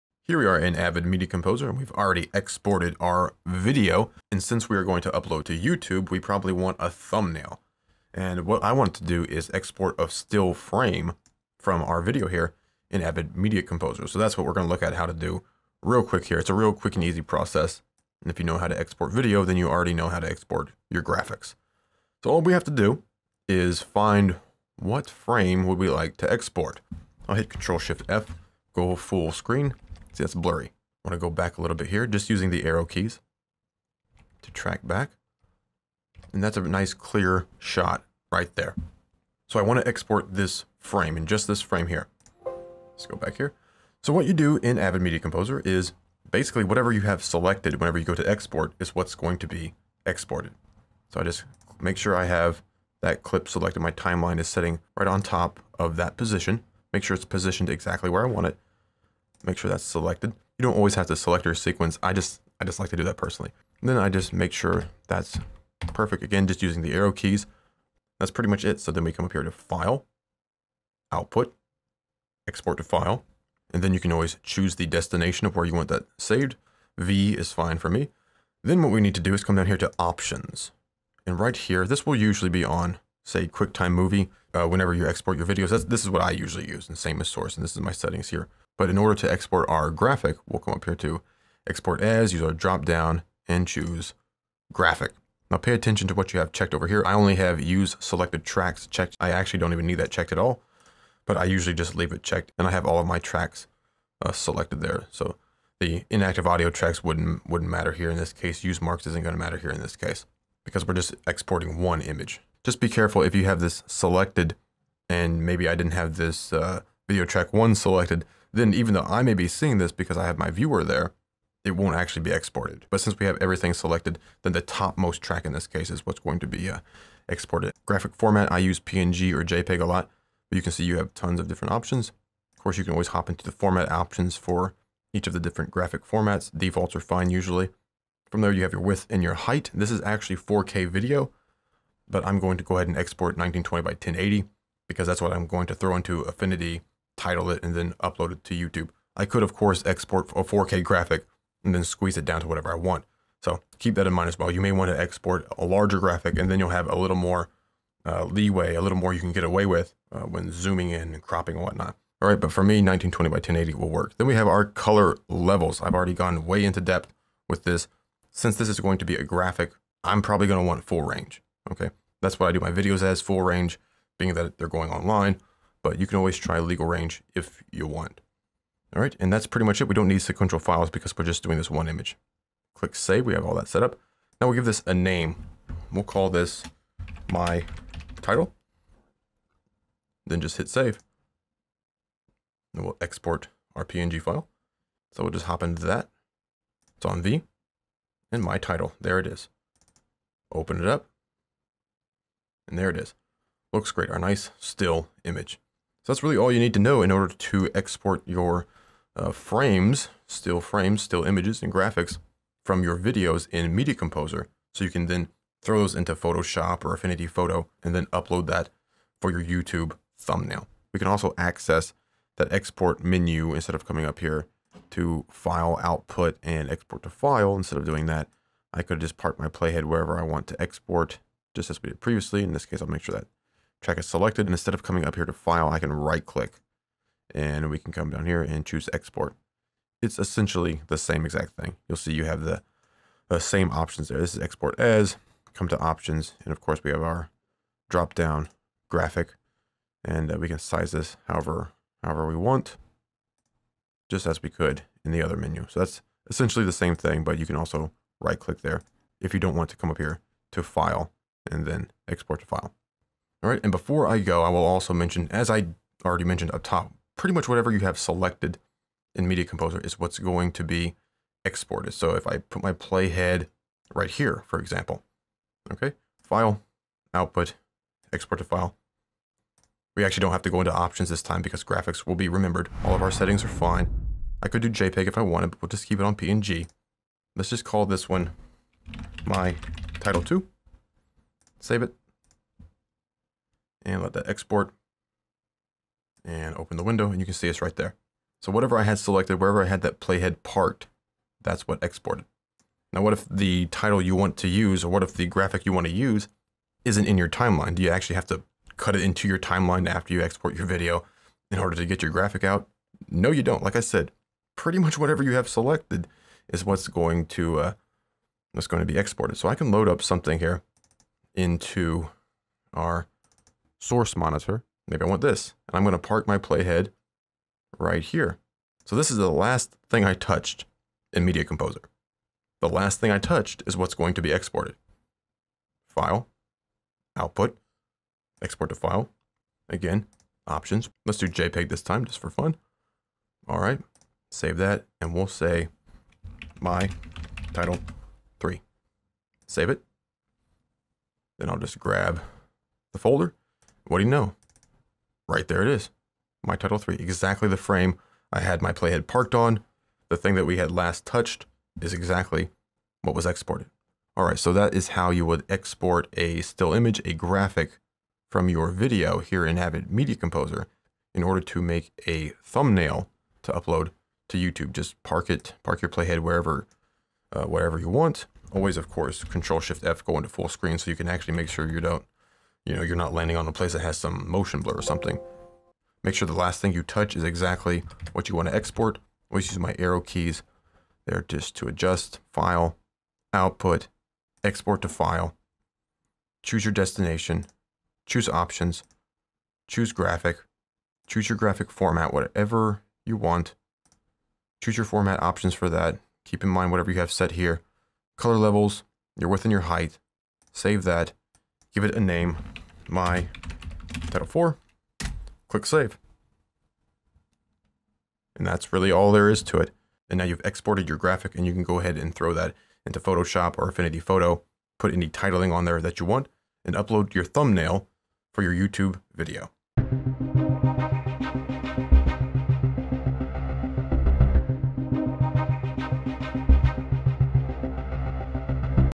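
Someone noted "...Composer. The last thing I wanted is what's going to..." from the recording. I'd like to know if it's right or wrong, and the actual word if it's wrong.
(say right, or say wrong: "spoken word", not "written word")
wrong: "touched", not "wanted".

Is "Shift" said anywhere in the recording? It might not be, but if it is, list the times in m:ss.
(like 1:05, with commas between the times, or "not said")
0:27, 6:19.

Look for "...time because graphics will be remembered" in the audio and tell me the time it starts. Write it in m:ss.
4:41.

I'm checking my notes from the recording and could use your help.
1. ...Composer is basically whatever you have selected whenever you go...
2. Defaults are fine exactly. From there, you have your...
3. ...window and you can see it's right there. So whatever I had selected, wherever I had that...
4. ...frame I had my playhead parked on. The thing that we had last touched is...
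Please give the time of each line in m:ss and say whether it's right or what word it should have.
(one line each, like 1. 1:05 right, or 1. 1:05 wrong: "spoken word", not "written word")
1. 0:45 right
2. 2:16 wrong: "usually", not "exactly"
3. 4:56 right
4. 5:57 right.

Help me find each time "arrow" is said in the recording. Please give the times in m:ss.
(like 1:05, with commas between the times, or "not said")
0:32, 1:06, 6:29.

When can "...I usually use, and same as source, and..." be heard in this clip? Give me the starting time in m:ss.
1:26.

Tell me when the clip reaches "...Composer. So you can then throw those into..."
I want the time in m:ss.
3:33.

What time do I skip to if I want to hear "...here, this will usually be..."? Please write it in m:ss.
1:21.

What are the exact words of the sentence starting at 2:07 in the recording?
Graphic format, I use PNG or JPEG a lot, but you can see you have tons of different options.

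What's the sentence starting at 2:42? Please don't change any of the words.
All right, but for me, 1920 by 1080 will work.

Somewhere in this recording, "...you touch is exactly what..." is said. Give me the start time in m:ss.
6:26.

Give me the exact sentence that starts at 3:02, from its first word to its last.
Click save, we have all that set up.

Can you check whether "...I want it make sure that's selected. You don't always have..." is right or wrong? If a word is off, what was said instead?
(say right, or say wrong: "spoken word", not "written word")
right.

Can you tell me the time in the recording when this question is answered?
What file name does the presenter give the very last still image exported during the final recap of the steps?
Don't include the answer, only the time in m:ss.
6:52.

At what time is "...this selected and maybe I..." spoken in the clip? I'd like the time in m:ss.
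1:53.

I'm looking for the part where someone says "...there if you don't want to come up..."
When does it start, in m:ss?
4:18.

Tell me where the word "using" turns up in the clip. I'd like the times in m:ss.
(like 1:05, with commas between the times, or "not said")
0:32, 1:06.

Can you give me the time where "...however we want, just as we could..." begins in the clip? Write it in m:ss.
4:12.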